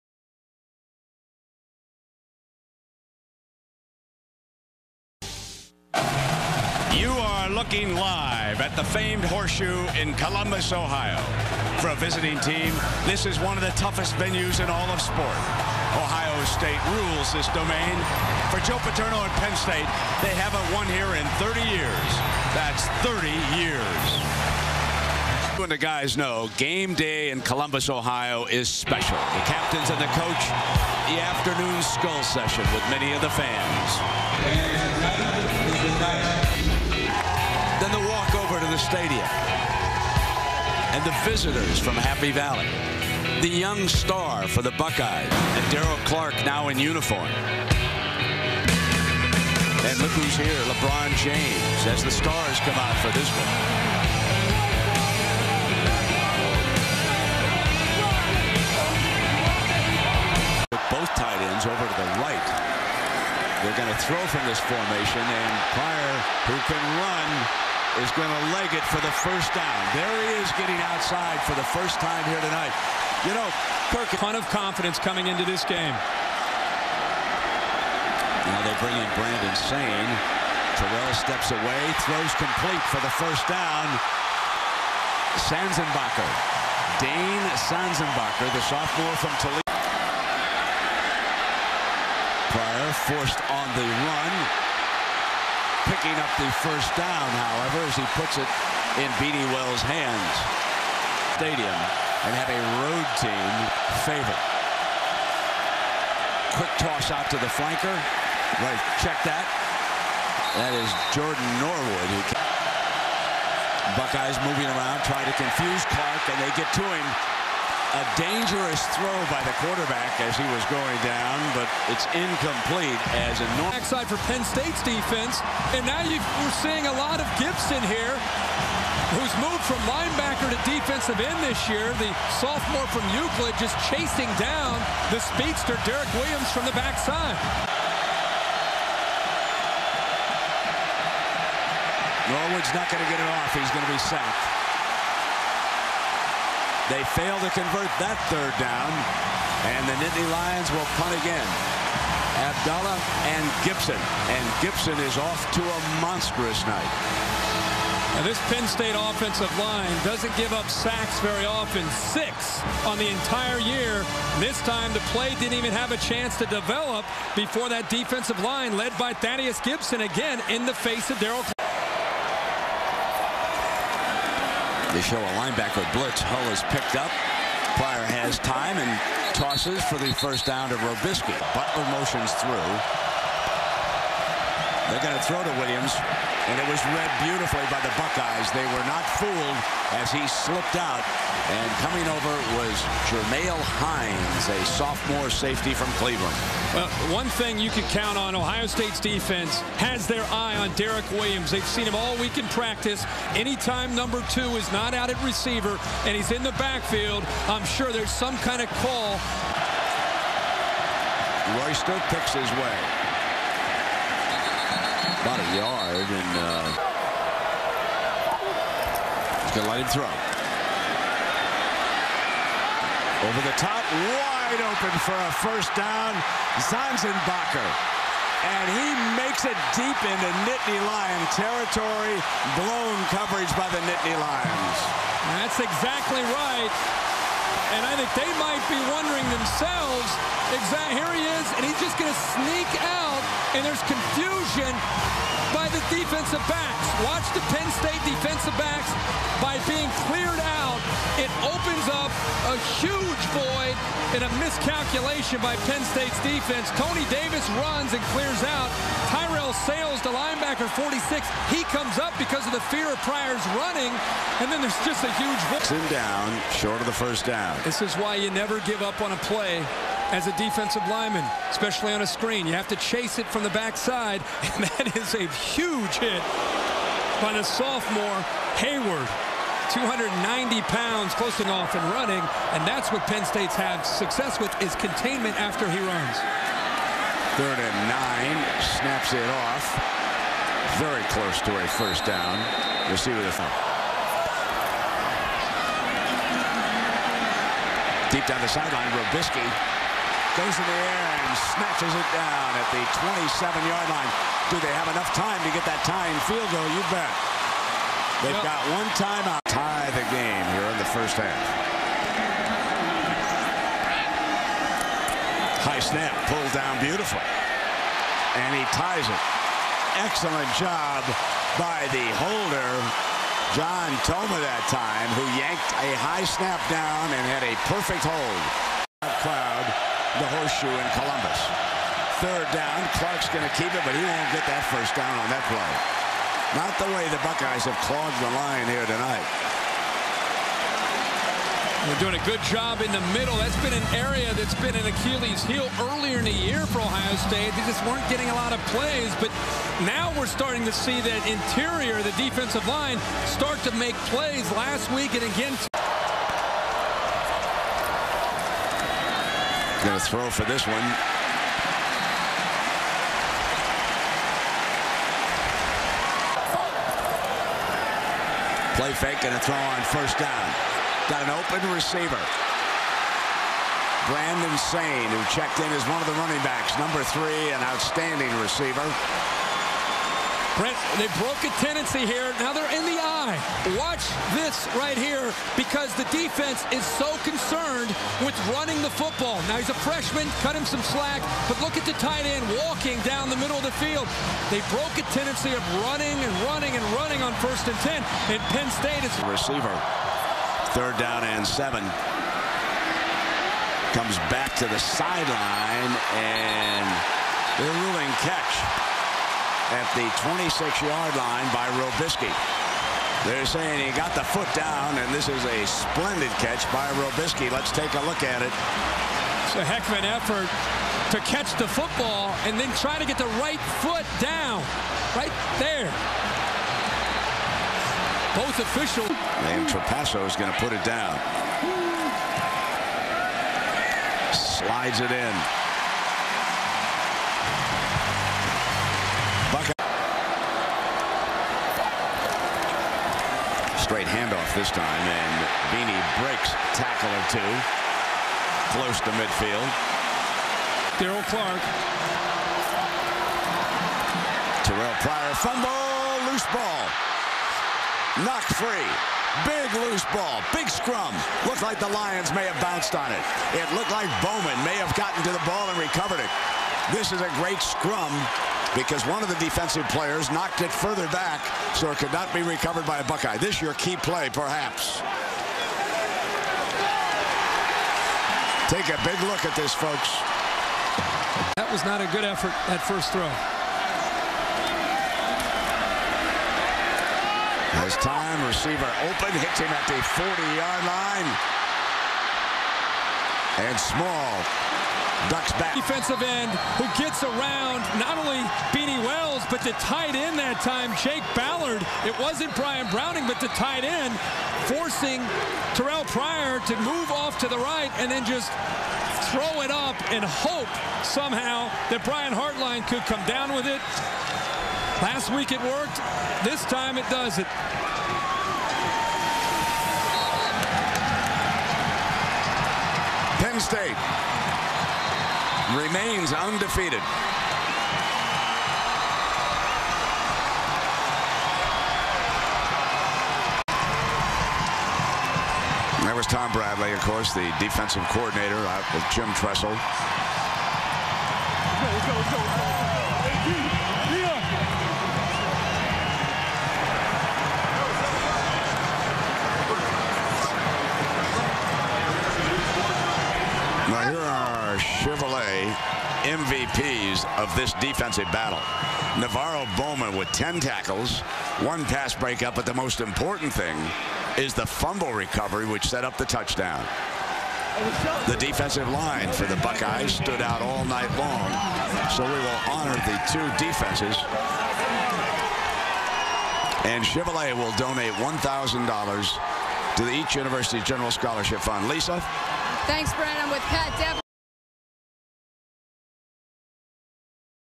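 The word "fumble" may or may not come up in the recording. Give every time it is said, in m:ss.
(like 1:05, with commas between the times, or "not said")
7:35, 9:24.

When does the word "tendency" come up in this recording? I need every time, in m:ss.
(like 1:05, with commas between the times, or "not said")
6:21, 6:35.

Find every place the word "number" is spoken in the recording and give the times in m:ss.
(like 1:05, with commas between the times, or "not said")
3:23, 6:16.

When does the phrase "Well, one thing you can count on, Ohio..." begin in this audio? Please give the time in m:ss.
3:16.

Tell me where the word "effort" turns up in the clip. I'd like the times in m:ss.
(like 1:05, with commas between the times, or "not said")
7:00, 8:02.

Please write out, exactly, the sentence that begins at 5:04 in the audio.
Do they have enough time to get that tying field goal?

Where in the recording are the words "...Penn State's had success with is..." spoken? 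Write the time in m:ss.
4:43.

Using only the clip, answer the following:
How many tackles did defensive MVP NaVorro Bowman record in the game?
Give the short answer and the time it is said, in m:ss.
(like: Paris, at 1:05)
10, at 9:20.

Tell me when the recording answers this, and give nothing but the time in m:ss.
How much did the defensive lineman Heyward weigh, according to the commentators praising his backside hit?
4:39.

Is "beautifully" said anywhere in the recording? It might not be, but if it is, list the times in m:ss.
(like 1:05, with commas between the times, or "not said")
3:07, 5:16.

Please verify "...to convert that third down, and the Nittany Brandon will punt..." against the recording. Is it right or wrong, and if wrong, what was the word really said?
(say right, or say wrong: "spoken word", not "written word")
wrong: "Lions", not "Brandon".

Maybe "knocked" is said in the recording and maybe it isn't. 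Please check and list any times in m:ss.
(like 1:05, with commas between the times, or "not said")
7:38, 7:50.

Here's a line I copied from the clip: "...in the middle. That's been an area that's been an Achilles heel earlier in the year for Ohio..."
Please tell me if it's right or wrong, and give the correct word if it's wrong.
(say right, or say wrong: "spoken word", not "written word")
right.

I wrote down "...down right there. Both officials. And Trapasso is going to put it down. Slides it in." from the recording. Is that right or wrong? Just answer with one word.
right.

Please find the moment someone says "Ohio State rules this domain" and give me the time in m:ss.
0:15.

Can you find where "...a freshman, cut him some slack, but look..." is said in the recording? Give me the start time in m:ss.
6:29.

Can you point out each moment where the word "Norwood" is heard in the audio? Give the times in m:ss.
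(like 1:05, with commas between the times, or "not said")
1:51, 2:22.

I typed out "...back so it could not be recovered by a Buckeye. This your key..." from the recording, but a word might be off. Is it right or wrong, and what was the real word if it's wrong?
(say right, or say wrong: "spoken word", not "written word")
right.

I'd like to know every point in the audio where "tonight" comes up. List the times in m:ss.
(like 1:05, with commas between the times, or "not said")
1:12, 5:38.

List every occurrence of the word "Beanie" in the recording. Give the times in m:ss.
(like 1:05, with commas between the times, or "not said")
1:39, 7:25, 8:18.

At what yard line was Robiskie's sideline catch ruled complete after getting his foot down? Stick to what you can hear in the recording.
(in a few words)
26.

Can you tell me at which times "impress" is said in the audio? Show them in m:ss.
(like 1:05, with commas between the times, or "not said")
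not said.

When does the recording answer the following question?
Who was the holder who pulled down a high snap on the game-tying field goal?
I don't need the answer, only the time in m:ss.
5:23.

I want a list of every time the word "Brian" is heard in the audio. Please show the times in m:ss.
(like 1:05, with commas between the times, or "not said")
8:22, 8:32.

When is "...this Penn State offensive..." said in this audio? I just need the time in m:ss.
2:38.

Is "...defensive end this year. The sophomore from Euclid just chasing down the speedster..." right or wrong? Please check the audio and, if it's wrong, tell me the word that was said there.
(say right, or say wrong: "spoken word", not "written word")
right.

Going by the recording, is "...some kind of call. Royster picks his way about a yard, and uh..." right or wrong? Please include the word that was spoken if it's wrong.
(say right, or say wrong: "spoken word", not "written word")
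right.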